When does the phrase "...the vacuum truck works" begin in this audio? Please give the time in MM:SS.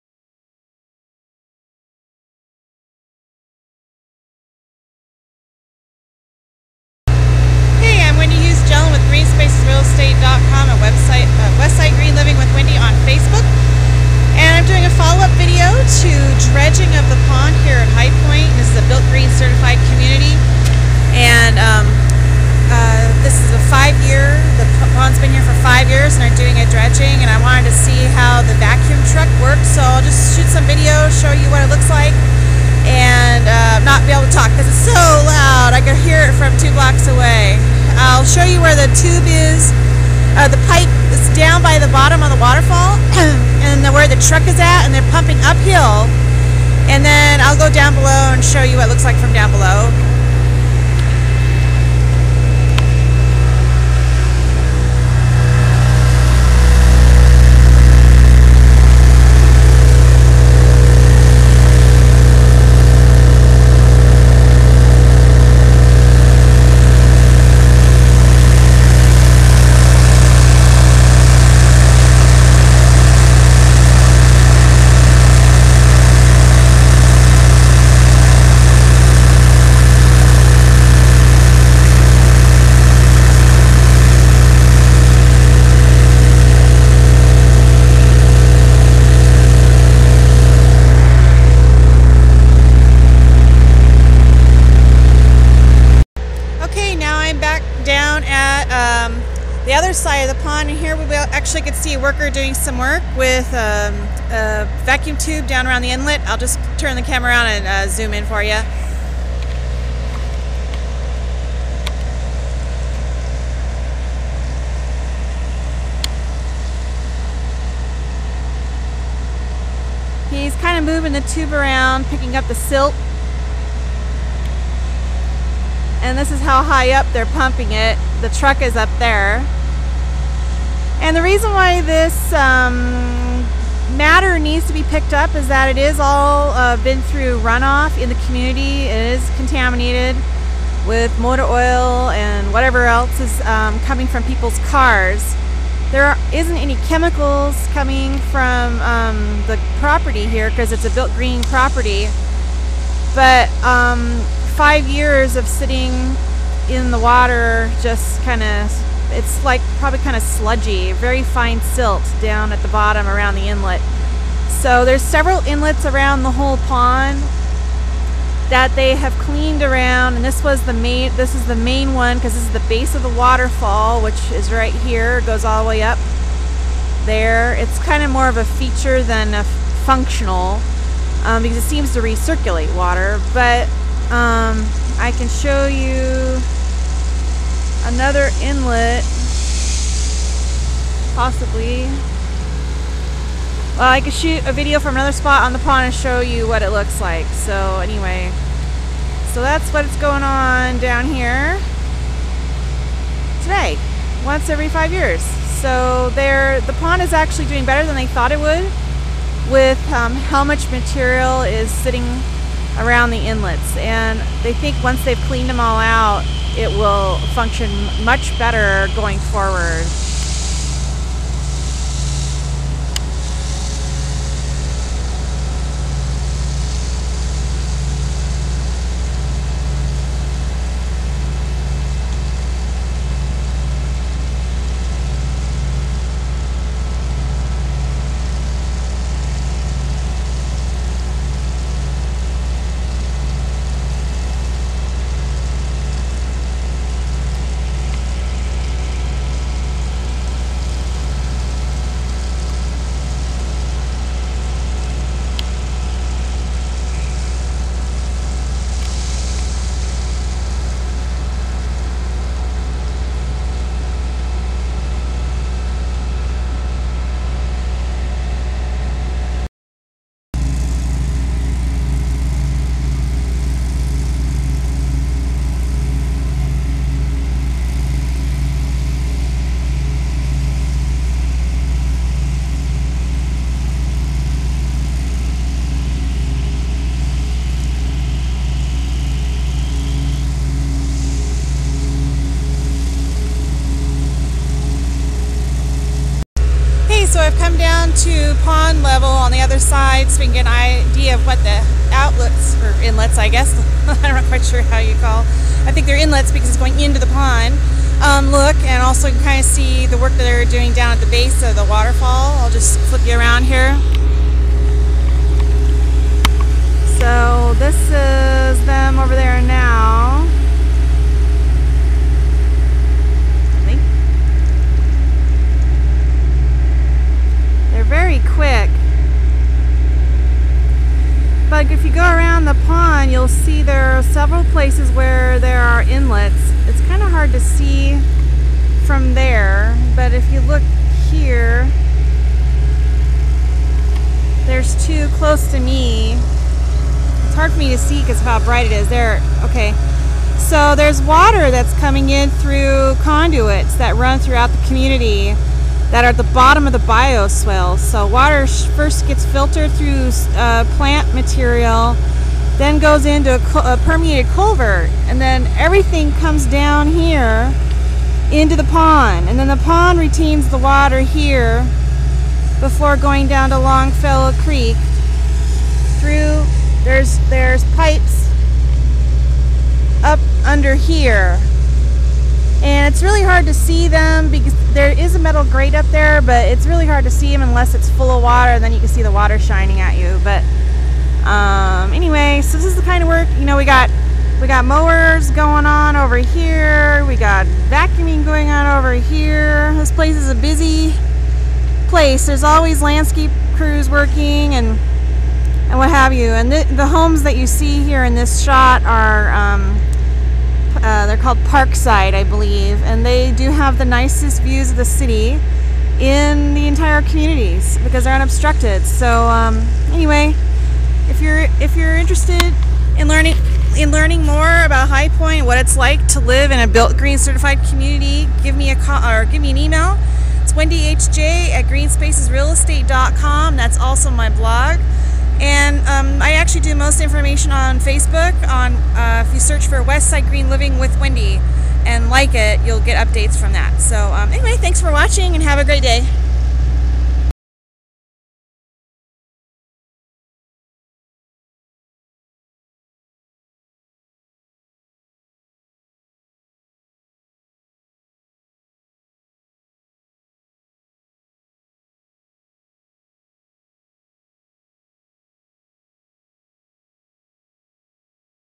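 00:28.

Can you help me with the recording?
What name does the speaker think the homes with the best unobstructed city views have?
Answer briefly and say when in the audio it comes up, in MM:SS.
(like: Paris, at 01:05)
Parkside, at 06:51.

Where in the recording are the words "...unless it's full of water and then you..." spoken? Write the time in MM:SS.
06:27.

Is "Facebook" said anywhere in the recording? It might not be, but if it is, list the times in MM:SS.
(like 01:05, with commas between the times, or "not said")
00:13, 07:17.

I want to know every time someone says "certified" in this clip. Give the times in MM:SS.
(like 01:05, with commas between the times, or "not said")
00:19, 07:07.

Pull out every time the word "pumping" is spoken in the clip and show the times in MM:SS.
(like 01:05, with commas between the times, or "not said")
00:45, 02:07.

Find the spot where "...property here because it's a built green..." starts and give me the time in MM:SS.
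02:29.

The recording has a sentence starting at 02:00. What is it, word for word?
He's kind of moving the tube around, picking up the silt.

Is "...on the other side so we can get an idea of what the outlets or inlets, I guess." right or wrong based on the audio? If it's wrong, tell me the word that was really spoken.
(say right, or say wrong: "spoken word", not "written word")
right.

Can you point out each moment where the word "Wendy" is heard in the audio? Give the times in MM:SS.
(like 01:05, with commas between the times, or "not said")
00:12, 07:10, 07:20.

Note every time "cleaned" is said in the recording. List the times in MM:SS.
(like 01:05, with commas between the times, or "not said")
02:49, 03:35.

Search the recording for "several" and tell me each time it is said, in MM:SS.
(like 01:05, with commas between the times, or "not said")
02:45, 05:34.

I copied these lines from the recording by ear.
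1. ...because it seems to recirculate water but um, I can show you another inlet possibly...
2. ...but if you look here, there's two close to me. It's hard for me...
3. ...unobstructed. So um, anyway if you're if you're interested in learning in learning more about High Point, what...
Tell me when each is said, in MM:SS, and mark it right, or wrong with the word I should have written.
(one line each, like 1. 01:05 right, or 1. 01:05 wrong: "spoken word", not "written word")
1. 03:01 right
2. 05:39 right
3. 06:58 right.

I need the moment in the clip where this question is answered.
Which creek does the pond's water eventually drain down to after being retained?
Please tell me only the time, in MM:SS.
06:13.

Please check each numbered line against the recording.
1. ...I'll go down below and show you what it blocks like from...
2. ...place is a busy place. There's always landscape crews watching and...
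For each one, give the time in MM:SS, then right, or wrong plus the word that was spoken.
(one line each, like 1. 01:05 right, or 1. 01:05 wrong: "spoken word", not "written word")
1. 00:47 wrong: "looks", not "blocks"
2. 06:39 wrong: "working", not "watching".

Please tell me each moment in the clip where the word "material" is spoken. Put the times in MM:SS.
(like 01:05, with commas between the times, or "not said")
03:30, 06:01.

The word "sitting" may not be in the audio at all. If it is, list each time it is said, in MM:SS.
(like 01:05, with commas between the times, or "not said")
02:35, 03:31.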